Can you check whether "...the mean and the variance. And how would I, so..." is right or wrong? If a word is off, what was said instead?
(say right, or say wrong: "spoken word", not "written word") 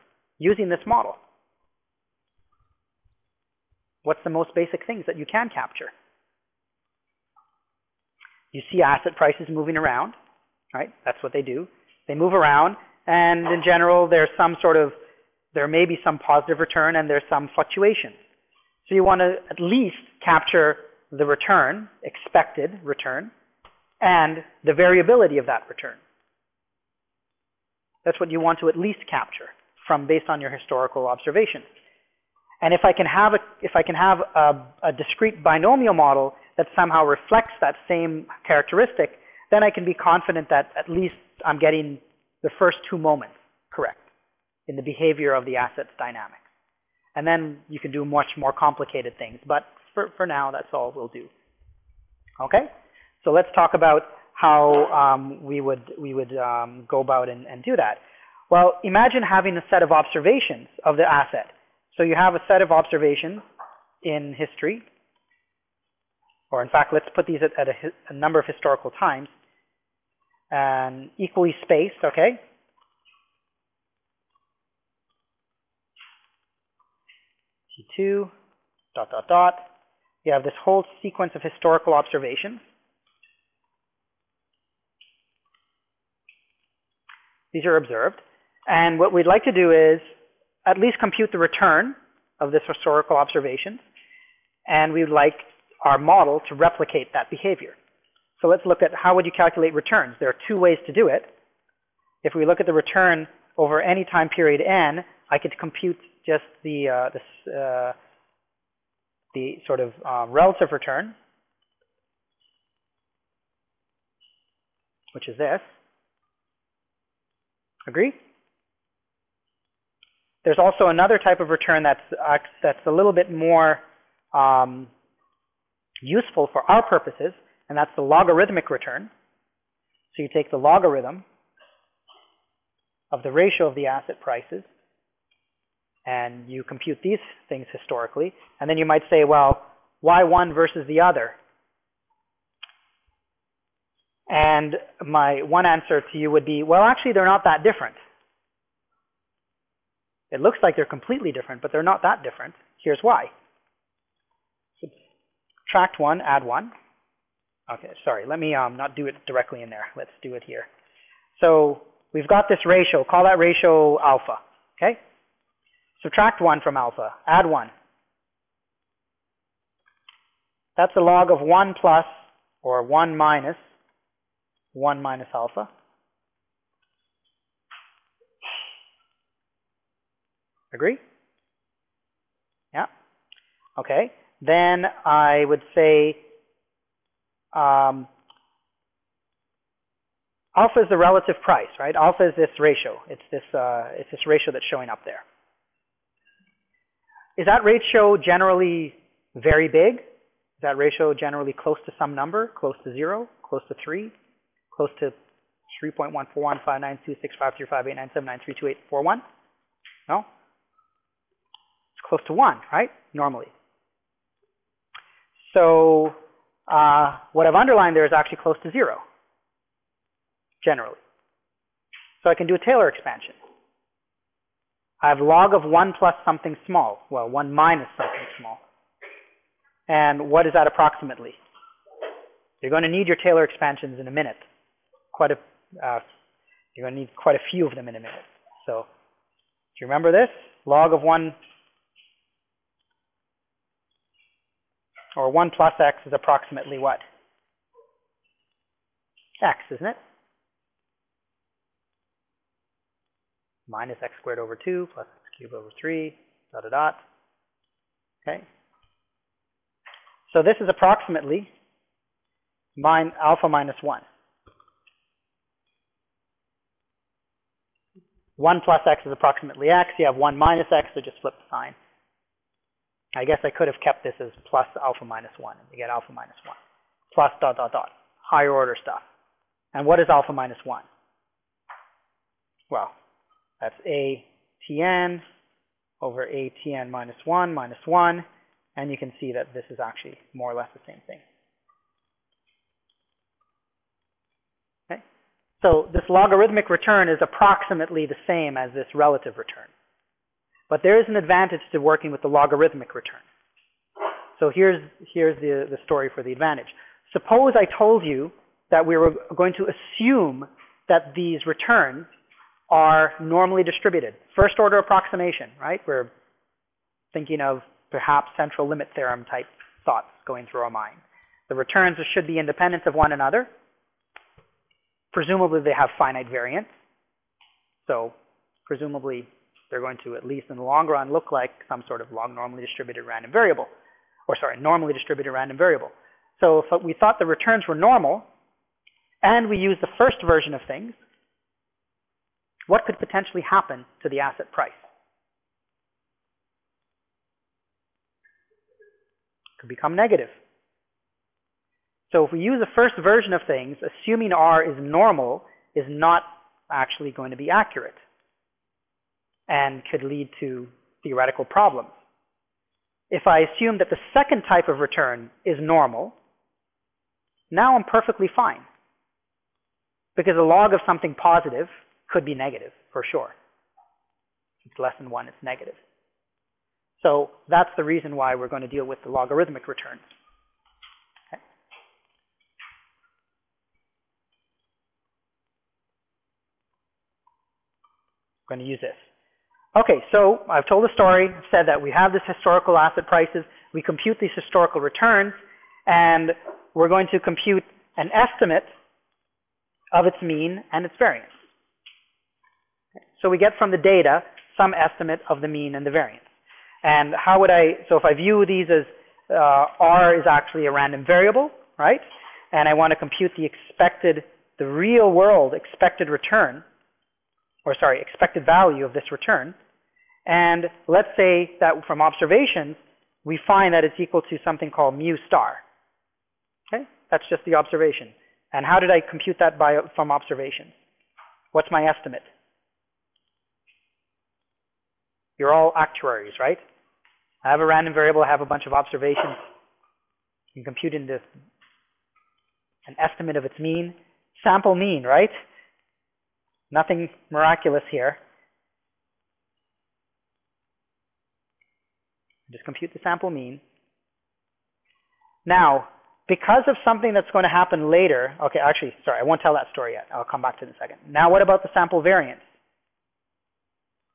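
right.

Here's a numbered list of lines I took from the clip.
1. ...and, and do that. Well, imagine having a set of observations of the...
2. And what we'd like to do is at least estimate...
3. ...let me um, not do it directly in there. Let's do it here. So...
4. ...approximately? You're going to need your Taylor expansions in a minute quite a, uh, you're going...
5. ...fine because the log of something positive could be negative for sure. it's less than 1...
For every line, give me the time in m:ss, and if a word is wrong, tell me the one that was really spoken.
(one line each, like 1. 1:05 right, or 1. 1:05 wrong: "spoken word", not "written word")
1. 0:57 right
2. 1:28 wrong: "compute", not "estimate"
3. 2:38 right
4. 3:50 right
5. 6:08 right.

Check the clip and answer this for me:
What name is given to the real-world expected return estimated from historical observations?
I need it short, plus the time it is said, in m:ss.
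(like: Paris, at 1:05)
Mu star, at 7:04.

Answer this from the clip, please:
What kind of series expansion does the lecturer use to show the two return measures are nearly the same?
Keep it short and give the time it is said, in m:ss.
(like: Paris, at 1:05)
Taylor expansion, at 3:42.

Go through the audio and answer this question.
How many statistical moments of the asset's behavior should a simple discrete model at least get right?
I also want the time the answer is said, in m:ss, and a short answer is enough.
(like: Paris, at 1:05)
2, at 0:42.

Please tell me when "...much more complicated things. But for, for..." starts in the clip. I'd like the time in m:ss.
0:48.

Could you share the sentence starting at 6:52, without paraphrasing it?
And I want to compute the expected, the real world expected return or sorry, expected value of this return.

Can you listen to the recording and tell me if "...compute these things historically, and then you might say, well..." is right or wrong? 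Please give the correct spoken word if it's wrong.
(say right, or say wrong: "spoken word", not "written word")
right.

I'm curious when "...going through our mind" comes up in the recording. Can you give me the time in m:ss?
5:20.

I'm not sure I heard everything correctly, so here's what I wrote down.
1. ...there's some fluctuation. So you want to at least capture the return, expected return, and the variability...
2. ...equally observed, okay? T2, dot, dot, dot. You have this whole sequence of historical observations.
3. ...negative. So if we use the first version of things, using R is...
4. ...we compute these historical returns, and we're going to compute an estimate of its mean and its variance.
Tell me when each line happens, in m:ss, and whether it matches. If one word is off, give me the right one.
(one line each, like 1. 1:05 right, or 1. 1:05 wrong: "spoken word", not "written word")
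1. 0:17 right
2. 1:11 wrong: "spaced", not "observed"
3. 5:49 wrong: "assuming", not "using"
4. 6:33 right.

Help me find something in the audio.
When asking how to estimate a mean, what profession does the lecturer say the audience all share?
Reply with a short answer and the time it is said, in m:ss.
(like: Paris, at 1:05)
Actuaries, at 7:15.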